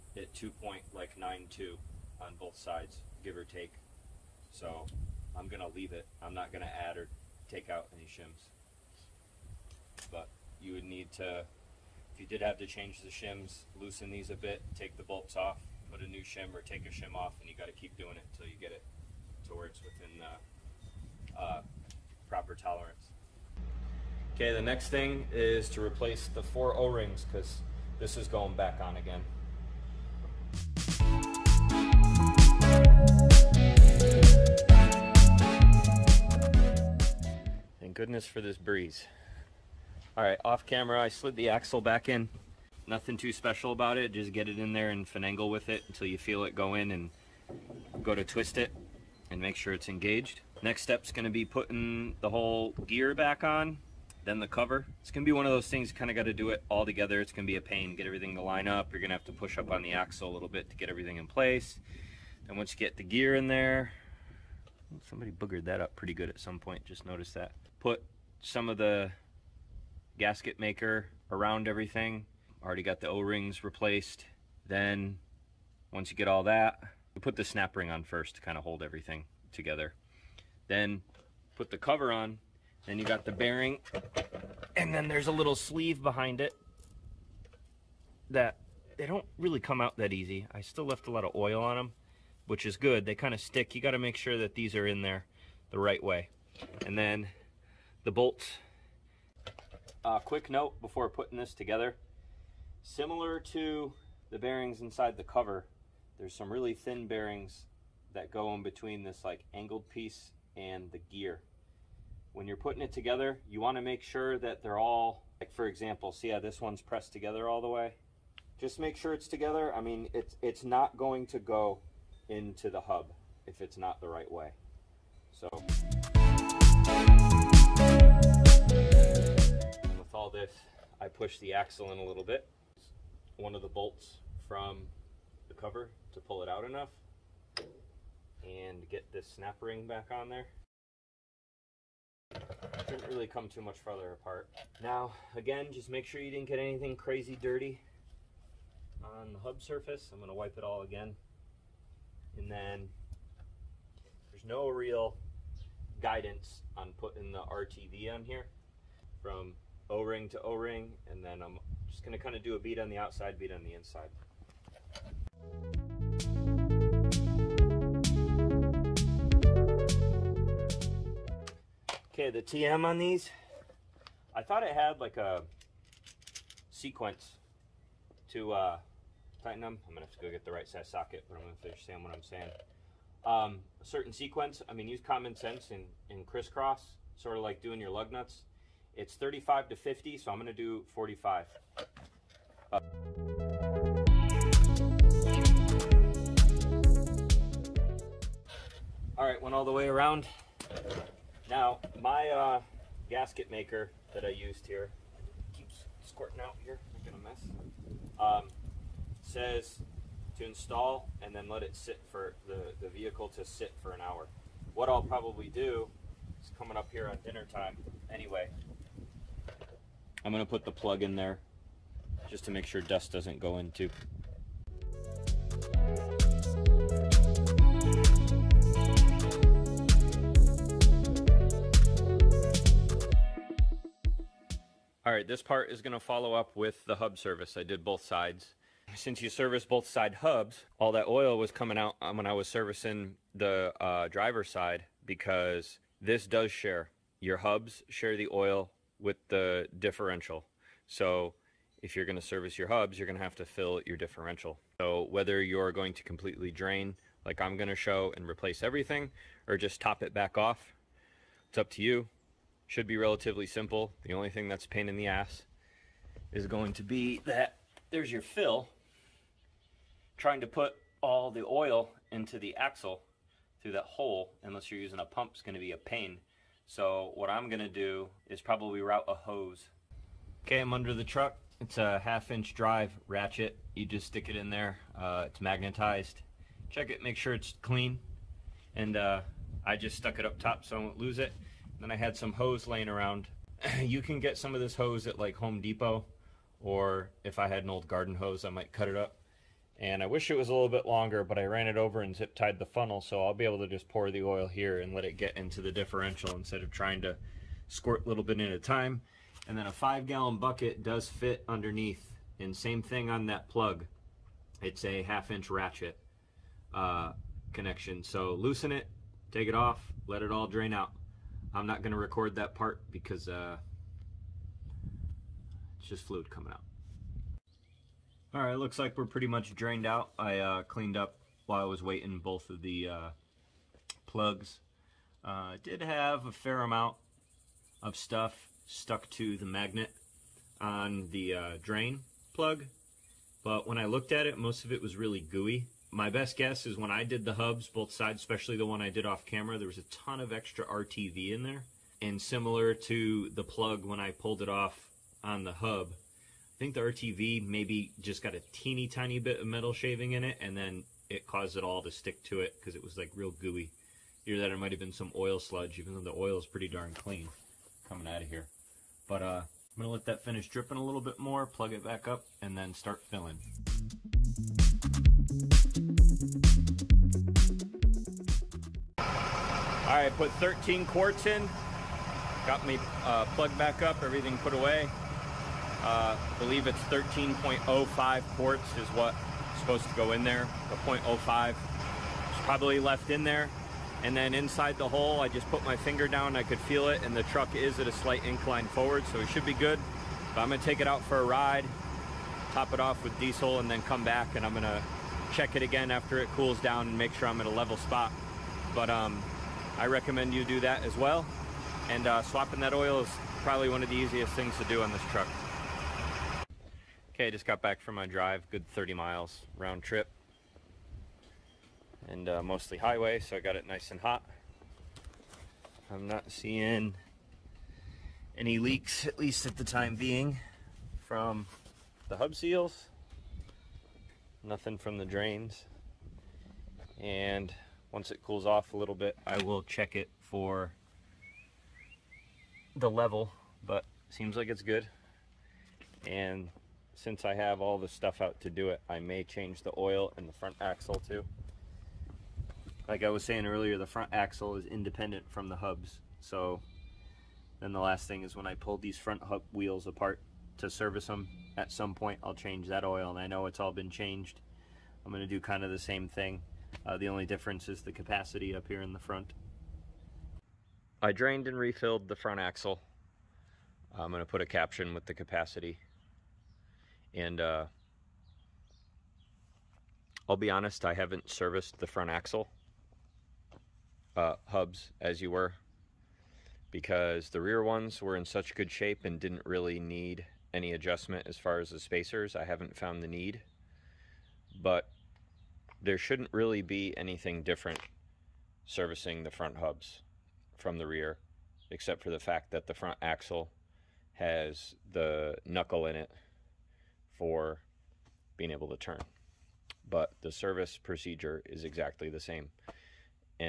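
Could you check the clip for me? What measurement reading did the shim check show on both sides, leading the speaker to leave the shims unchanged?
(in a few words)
2.92.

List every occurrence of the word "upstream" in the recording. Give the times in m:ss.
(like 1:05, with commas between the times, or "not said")
not said.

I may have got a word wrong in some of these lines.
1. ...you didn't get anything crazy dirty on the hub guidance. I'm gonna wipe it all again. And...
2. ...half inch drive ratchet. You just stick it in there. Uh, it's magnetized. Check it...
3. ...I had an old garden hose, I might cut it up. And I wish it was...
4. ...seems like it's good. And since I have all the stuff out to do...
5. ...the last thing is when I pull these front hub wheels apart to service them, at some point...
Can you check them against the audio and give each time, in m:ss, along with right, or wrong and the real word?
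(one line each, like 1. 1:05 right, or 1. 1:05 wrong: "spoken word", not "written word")
1. 2:26 wrong: "surface", not "guidance"
2. 4:41 right
3. 4:57 right
4. 7:24 right
5. 7:37 right.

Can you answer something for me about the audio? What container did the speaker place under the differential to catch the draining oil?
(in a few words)
five gallon bucket.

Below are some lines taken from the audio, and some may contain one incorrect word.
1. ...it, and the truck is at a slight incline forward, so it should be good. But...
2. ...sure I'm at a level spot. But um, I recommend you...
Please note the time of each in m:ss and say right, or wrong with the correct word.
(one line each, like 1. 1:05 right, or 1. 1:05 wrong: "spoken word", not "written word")
1. 6:36 right
2. 6:47 right.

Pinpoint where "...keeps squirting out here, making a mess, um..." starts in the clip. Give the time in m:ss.
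3:25.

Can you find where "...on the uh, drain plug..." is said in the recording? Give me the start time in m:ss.
5:40.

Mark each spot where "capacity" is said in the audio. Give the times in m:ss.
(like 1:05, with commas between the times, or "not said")
7:47, 7:55.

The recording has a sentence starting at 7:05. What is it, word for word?
I'm not seeing any leaks, at least at the time being, from the hub seals.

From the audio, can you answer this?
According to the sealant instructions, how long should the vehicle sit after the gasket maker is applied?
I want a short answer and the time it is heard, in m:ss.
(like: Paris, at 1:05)
an hour, at 3:33.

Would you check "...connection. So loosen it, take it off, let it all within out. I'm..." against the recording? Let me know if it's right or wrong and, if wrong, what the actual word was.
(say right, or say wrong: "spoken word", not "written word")
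wrong: "drain", not "within".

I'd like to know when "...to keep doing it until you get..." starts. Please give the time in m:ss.
0:17.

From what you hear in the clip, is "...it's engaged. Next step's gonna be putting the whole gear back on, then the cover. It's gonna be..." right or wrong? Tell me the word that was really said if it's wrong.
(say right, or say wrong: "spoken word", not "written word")
right.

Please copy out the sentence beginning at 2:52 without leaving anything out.
Okay, the TM on these, I thought it had like a sequence to uh, tighten them.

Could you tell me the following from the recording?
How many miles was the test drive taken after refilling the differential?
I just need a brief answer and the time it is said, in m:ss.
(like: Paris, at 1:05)
30 miles, at 6:58.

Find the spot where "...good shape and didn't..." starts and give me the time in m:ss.
8:08.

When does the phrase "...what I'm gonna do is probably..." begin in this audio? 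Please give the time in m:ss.
4:37.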